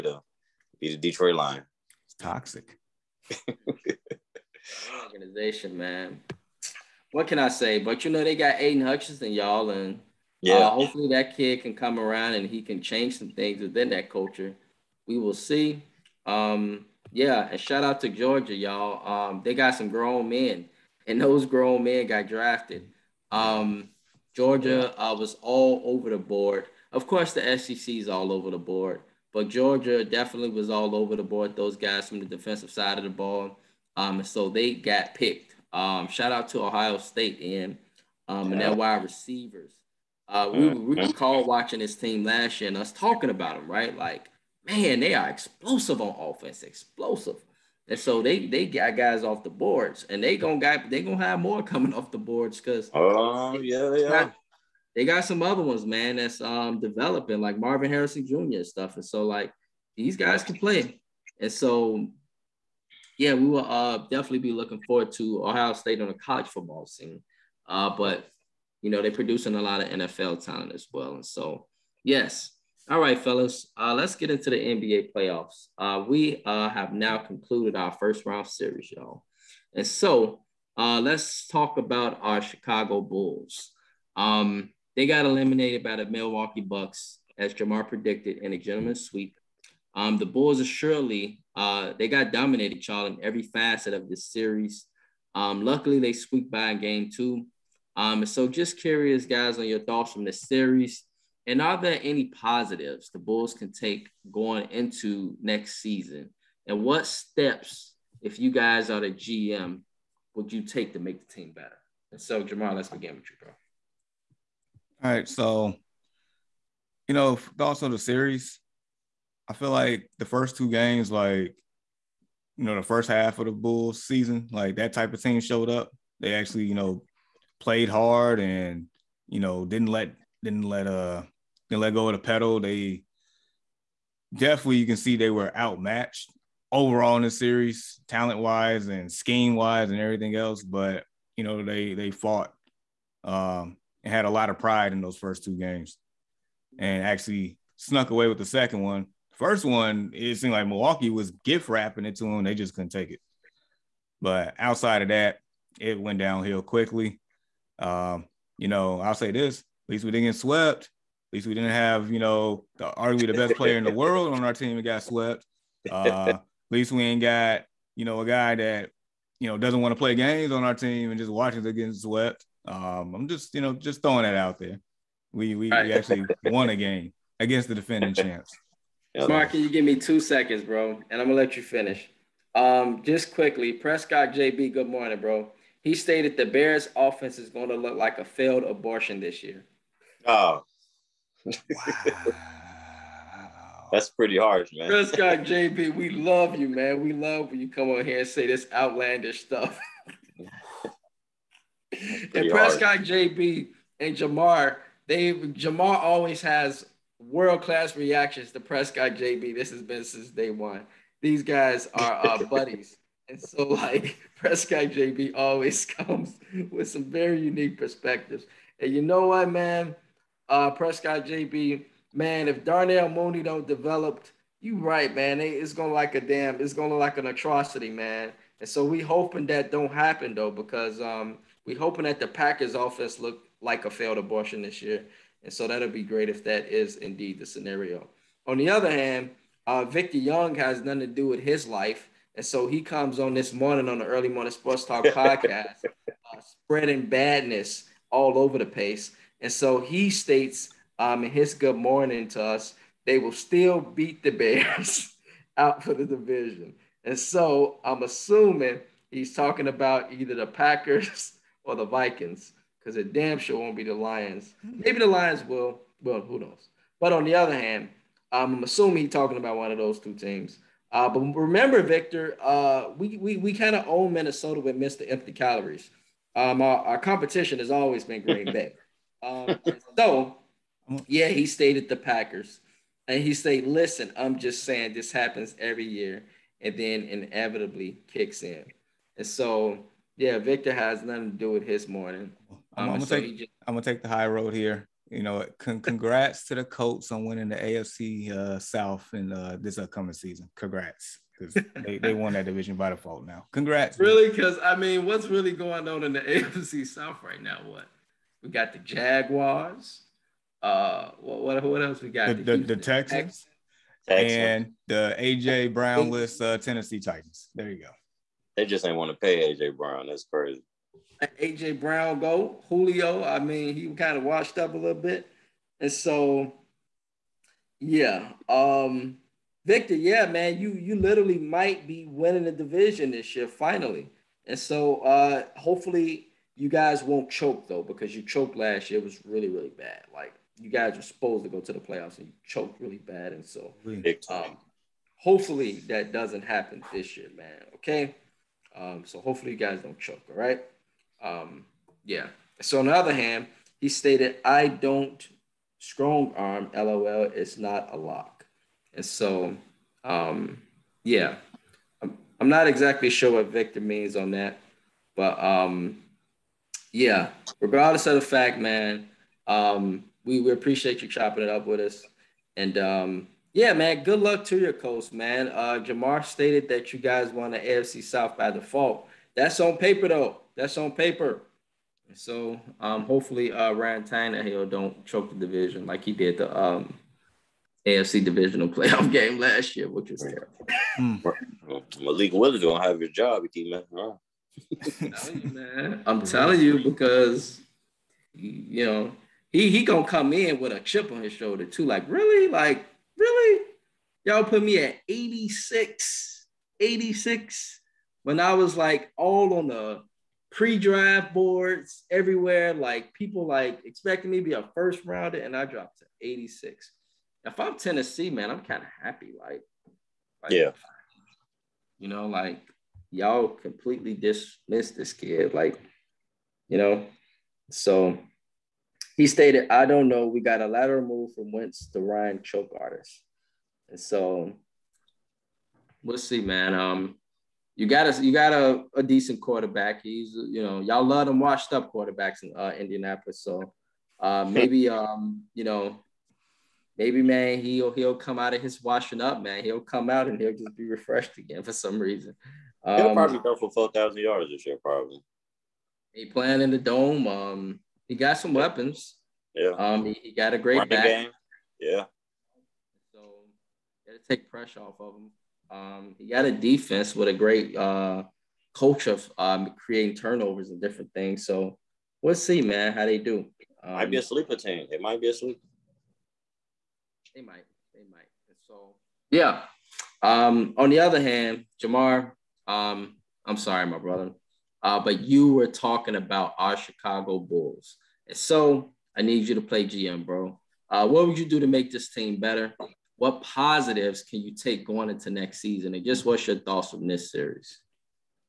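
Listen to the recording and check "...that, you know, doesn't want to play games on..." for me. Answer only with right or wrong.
right.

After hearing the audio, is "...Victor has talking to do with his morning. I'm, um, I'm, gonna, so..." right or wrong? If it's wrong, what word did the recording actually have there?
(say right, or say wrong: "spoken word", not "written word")
wrong: "nothing", not "talking".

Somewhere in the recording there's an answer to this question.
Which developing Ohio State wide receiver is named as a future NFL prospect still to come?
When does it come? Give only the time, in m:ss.
0:57.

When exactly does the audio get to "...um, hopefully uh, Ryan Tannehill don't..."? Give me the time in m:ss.
6:22.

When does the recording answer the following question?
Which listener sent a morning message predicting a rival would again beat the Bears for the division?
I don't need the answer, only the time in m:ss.
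3:59.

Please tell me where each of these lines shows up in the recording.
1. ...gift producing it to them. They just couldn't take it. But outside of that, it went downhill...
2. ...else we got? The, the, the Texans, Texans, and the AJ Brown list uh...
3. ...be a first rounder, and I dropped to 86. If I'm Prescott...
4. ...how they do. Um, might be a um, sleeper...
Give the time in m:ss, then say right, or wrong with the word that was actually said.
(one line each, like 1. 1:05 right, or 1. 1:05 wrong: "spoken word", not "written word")
1. 2:31 wrong: "wrapping", not "producing"
2. 5:11 right
3. 6:54 wrong: "Tennessee", not "Prescott"
4. 7:52 right.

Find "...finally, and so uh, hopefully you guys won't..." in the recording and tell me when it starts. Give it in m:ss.
5:33.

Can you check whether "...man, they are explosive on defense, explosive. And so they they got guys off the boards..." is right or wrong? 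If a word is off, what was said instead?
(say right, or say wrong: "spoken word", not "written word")
wrong: "offense", not "defense".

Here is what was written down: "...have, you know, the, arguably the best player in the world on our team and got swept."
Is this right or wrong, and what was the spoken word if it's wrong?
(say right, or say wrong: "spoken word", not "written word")
right.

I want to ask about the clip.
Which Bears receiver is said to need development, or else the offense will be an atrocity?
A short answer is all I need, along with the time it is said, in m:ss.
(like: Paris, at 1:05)
Darnell Mooney, at 3:42.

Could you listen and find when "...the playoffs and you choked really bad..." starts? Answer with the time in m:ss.
5:41.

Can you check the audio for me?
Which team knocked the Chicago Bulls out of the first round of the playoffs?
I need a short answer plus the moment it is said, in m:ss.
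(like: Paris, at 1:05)
Milwaukee Bucks, at 1:26.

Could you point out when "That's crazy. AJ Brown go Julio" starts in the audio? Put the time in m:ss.
5:20.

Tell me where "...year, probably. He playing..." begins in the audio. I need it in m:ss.
7:34.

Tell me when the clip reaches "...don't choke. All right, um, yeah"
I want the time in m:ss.
5:49.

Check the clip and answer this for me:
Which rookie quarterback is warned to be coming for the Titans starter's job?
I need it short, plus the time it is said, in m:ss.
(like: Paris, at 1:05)
Malik Willis, at 6:32.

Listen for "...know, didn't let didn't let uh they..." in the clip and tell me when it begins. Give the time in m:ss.
2:09.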